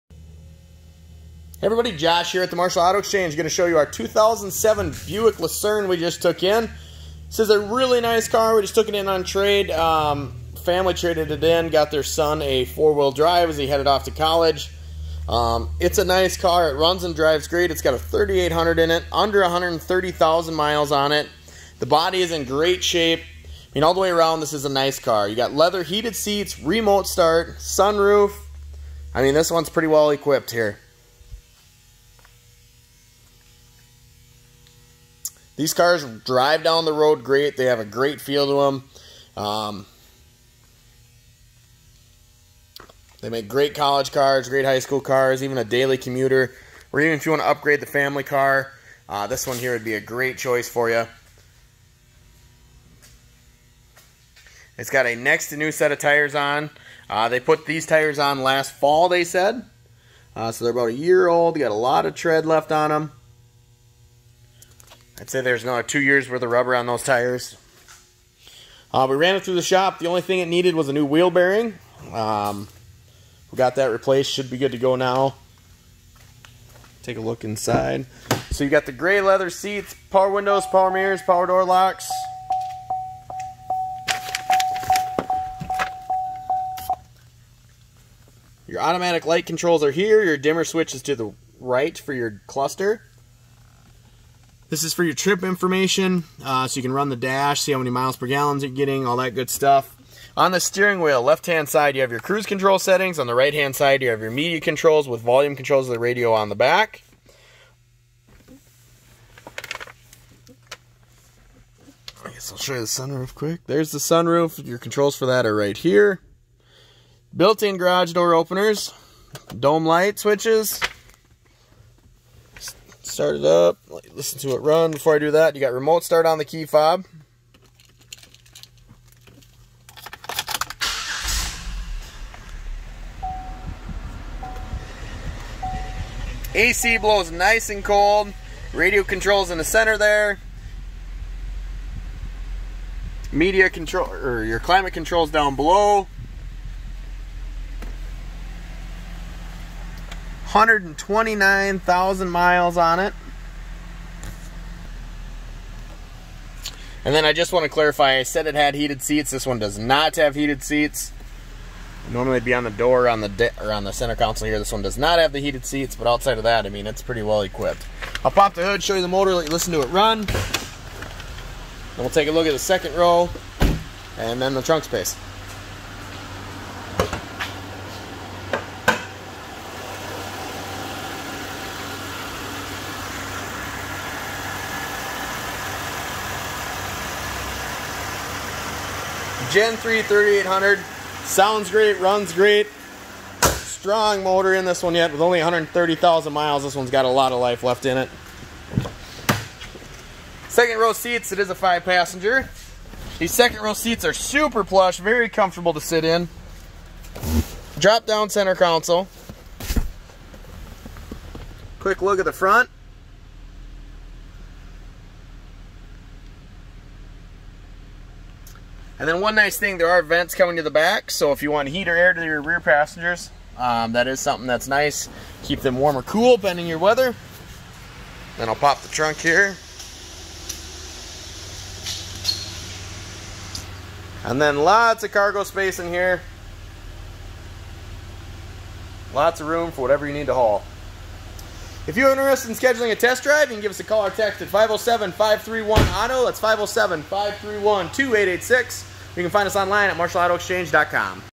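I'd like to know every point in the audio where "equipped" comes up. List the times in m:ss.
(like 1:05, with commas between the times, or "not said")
0:30, 2:47.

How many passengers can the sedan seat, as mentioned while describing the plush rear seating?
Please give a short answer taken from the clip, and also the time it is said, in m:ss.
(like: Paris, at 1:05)
5, at 3:21.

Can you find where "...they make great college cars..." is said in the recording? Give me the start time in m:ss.
0:43.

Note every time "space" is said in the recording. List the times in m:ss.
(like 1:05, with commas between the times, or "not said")
2:54, 3:55.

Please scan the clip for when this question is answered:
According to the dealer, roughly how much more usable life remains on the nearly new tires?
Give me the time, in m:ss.
1:05.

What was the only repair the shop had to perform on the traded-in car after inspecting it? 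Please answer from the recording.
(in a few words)
new wheel bearing.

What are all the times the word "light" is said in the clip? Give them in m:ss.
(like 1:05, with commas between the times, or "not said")
1:29, 1:59.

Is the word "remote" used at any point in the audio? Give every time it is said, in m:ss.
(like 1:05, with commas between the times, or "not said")
0:26, 2:05.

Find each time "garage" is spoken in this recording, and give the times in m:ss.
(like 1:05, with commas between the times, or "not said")
1:57.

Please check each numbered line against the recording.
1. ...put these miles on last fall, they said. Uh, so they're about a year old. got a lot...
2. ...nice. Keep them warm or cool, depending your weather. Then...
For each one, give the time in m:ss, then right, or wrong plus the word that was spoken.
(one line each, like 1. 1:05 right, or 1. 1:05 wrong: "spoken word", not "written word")
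1. 0:57 wrong: "tires", not "miles"
2. 3:44 right.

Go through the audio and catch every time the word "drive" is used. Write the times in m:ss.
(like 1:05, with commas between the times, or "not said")
0:13, 0:17, 0:36, 4:03.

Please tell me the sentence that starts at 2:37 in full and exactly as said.
And then I just want to clarify, I said it had heated seats.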